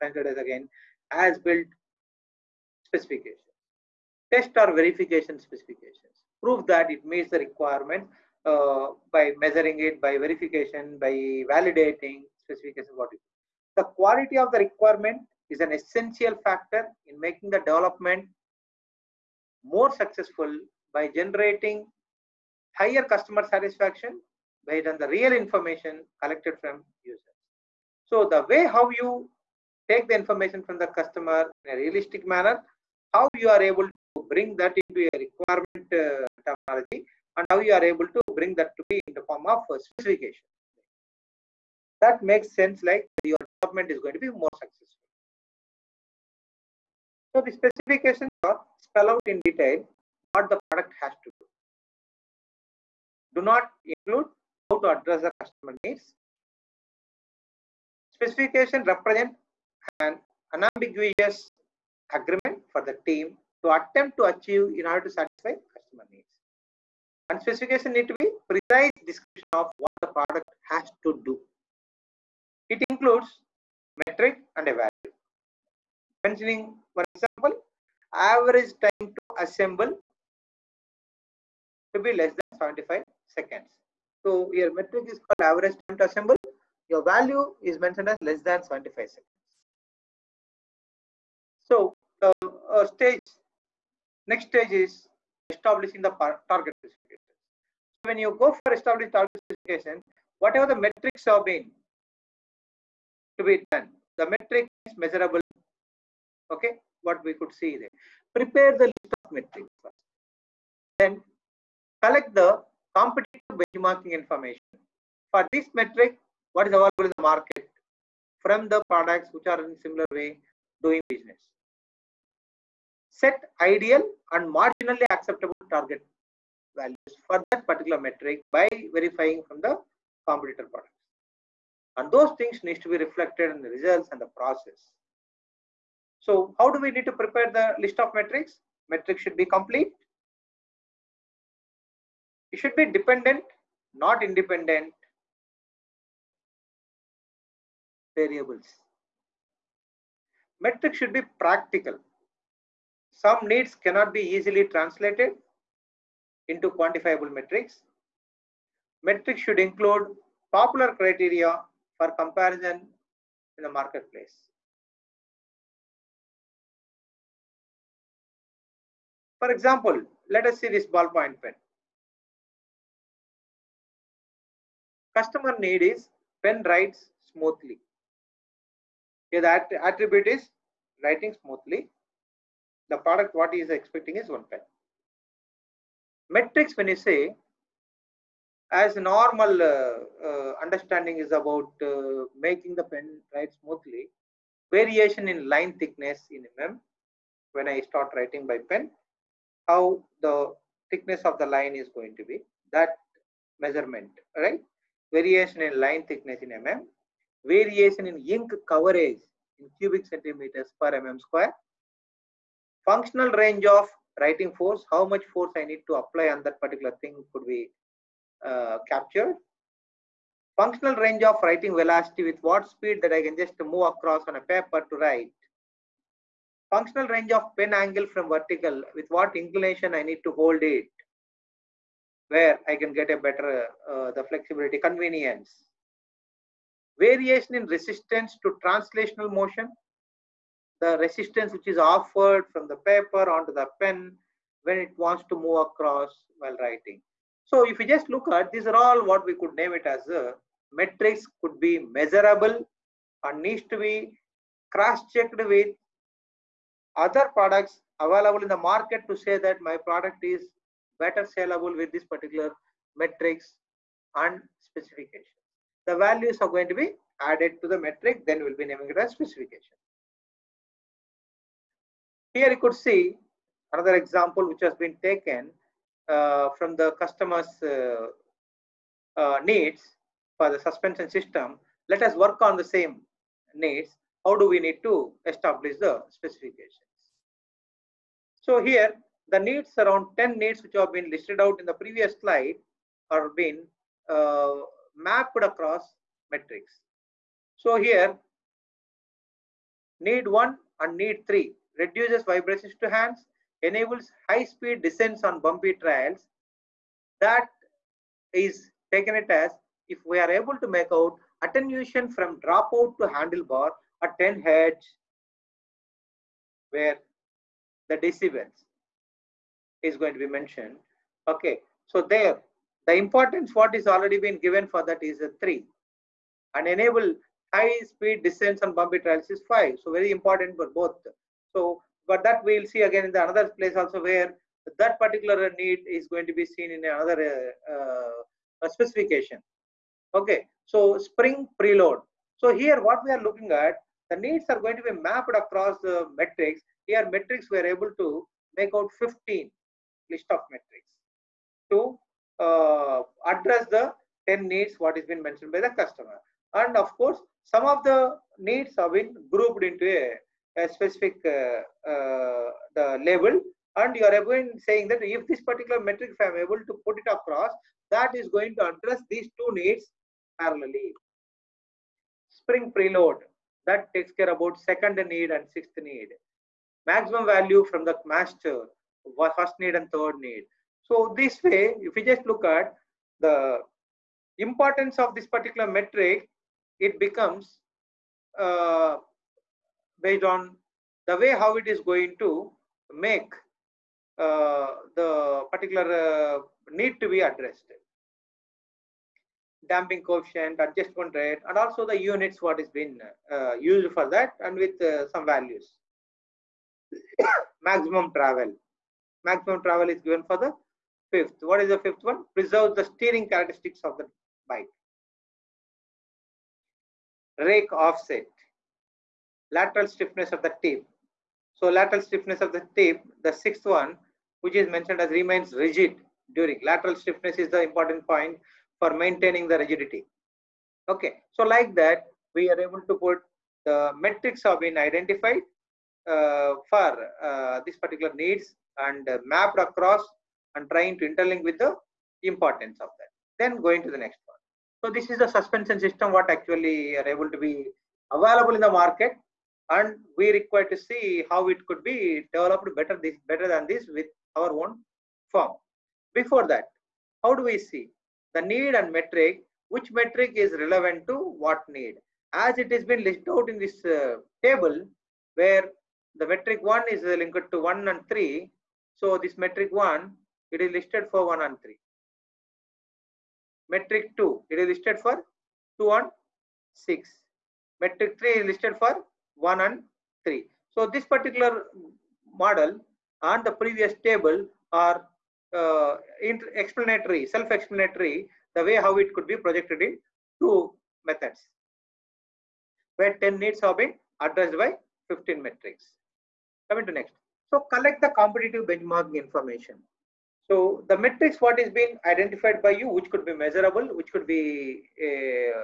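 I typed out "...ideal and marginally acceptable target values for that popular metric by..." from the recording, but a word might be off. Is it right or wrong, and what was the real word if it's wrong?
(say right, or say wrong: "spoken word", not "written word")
wrong: "particular", not "popular".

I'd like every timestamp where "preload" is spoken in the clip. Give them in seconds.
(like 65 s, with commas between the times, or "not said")
341 s, 372 s.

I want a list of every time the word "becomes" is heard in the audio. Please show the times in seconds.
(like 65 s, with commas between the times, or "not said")
386 s.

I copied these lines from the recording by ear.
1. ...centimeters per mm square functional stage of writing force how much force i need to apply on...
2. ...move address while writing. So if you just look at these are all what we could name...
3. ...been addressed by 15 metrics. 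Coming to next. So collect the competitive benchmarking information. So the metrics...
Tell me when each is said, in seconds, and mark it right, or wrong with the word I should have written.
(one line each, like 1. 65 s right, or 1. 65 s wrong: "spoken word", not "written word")
1. 210 s wrong: "range", not "stage"
2. 245 s wrong: "across", not "address"
3. 493 s right.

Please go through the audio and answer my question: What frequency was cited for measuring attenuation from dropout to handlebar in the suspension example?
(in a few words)
10 hertz.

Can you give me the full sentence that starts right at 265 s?
The values are going to be added to the metric, then we'll be naming it as specification.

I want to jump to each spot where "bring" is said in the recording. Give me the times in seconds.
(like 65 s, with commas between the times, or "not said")
34 s, 38 s.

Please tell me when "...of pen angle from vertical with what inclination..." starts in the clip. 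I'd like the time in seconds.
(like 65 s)
227 s.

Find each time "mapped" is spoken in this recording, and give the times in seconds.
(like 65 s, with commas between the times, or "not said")
294 s, 344 s, 439 s.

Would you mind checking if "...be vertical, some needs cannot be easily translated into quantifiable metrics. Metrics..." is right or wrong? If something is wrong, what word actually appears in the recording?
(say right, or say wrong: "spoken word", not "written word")
wrong: "practical", not "vertical".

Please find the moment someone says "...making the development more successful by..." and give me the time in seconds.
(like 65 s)
17 s.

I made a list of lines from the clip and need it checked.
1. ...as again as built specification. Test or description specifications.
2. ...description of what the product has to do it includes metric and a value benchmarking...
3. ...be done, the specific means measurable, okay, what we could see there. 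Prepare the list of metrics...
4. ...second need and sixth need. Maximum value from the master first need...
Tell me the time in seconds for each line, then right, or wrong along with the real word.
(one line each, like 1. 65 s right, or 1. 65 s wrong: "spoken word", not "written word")
1. 0 s wrong: "verification", not "description"
2. 69 s wrong: "mentioning", not "benchmarking"
3. 103 s wrong: "metric", not "specific"
4. 374 s right.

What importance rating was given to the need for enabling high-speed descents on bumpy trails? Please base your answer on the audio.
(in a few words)
5.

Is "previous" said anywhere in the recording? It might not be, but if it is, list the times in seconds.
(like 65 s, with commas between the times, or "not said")
291 s, 483 s.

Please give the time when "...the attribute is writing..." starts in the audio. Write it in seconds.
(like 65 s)
179 s.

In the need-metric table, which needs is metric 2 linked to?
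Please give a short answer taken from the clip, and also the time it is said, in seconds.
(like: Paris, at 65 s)
2 and 6, at 475 s.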